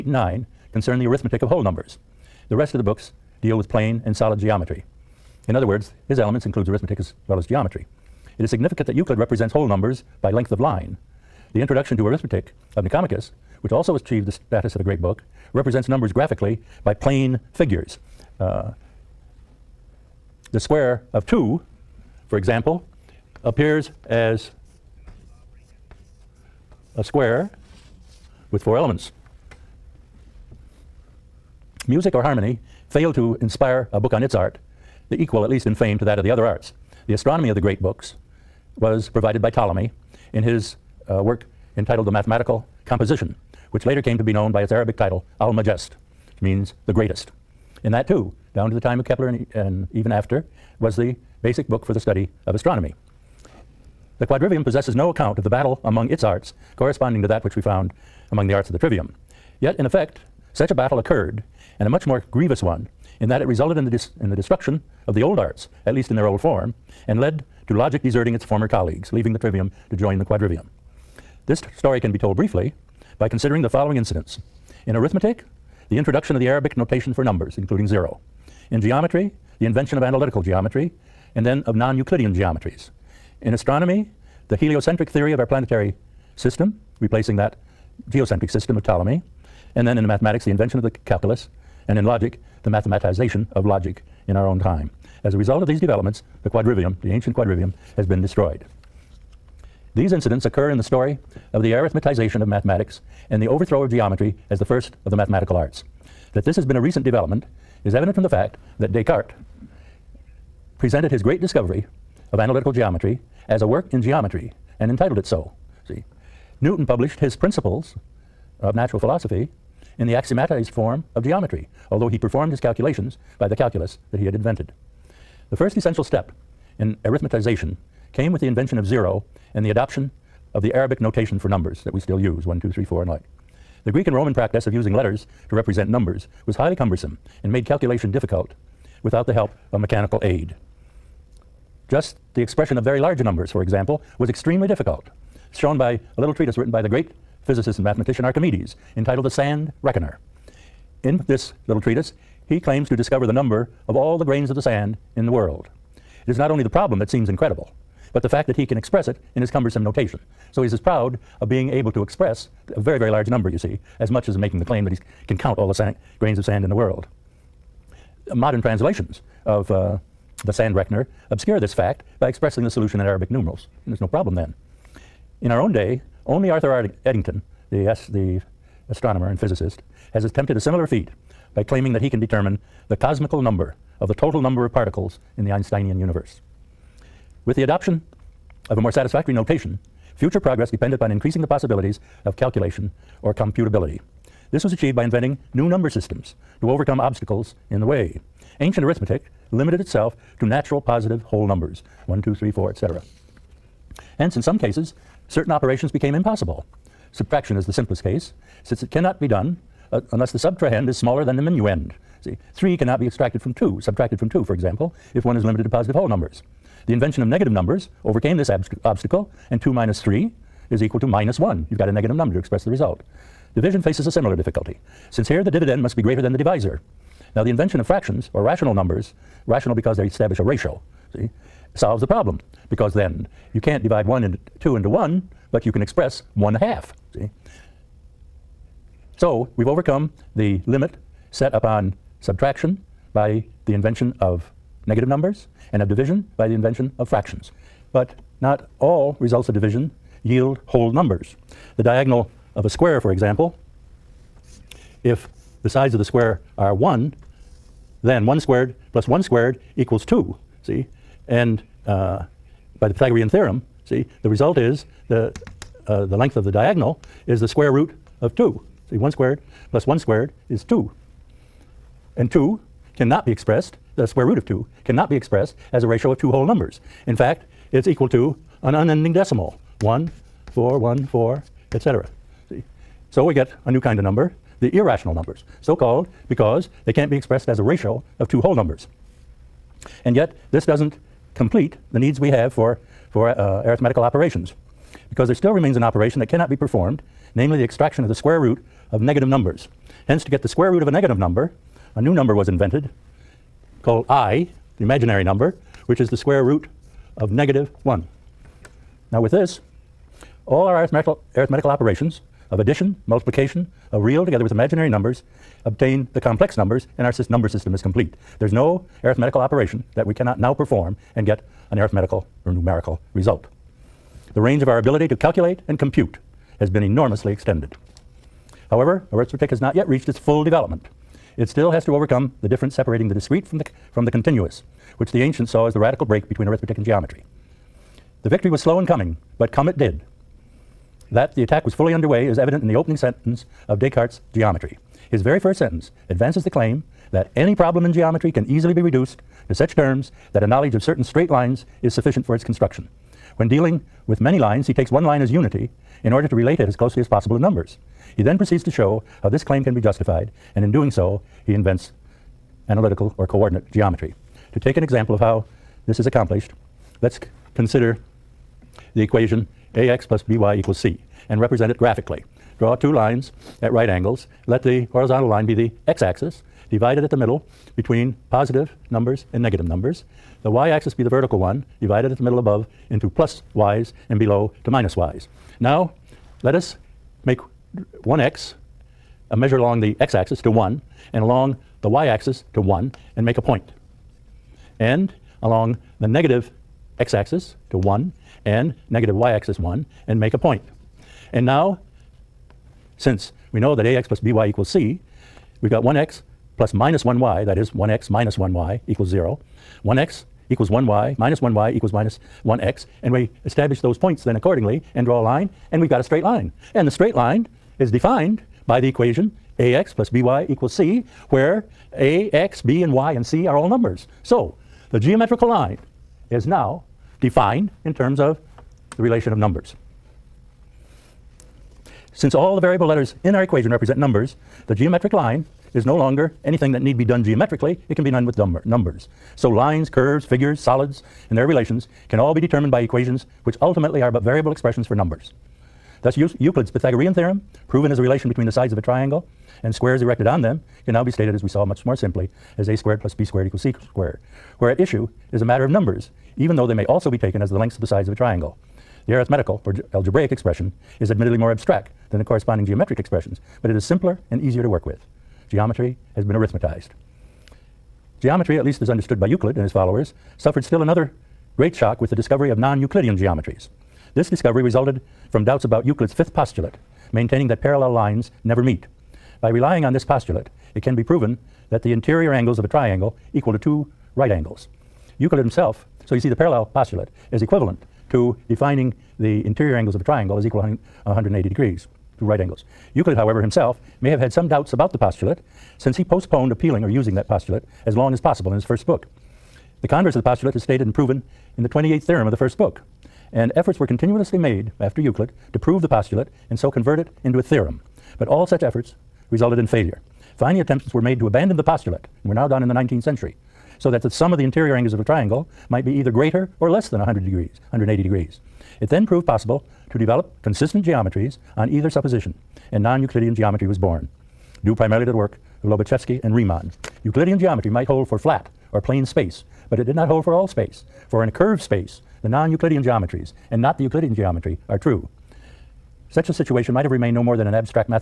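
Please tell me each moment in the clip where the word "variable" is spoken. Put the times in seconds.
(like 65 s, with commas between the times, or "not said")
432 s, 444 s.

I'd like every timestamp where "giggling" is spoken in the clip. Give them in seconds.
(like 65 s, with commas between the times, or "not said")
not said.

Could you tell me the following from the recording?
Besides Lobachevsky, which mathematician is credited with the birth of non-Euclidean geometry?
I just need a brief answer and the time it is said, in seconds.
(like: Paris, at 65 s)
Riemann, at 526 s.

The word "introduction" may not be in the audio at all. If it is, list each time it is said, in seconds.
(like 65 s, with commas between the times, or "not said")
11 s, 75 s.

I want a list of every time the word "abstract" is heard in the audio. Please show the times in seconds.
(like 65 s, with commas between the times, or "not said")
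461 s, 537 s.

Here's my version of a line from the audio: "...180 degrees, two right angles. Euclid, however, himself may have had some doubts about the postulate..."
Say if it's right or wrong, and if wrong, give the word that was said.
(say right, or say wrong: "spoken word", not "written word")
right.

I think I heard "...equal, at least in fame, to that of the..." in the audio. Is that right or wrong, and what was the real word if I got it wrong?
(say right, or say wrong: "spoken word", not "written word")
right.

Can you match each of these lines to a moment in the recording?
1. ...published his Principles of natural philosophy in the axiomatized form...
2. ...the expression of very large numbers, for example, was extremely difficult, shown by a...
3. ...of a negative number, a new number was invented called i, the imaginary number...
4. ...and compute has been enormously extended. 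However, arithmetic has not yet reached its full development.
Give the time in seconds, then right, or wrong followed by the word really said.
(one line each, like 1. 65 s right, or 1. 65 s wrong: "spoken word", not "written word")
1. 116 s right
2. 142 s right
3. 300 s right
4. 325 s right.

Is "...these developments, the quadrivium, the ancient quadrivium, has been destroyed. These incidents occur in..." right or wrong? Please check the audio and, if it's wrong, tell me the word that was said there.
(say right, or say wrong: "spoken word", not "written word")
right.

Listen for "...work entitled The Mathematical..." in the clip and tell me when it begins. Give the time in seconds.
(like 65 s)
41 s.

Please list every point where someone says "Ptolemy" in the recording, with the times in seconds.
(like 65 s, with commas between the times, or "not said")
39 s, 88 s.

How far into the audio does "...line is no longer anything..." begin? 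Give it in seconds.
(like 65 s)
435 s.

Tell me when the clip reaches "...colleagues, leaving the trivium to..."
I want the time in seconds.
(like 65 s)
68 s.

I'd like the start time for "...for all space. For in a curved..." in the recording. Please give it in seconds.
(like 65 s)
530 s.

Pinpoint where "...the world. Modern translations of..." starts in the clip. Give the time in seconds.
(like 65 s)
166 s.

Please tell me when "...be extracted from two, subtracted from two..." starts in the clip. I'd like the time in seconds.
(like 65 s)
212 s.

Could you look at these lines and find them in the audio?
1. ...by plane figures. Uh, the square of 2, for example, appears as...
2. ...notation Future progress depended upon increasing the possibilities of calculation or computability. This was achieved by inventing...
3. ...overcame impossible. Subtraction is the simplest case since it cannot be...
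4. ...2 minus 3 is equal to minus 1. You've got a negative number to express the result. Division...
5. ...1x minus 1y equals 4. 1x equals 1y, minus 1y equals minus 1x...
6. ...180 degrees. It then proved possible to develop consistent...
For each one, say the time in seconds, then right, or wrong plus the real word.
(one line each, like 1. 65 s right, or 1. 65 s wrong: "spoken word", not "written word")
1. 16 s right
2. 189 s right
3. 205 s wrong: "became", not "overcame"
4. 219 s right
5. 407 s wrong: "0", not "4"
6. 517 s right.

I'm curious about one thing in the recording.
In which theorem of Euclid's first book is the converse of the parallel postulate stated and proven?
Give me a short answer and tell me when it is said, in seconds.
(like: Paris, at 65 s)
28th, at 501 s.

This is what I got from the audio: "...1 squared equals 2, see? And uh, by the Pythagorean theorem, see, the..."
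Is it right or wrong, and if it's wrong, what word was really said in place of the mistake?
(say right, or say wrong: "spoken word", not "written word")
right.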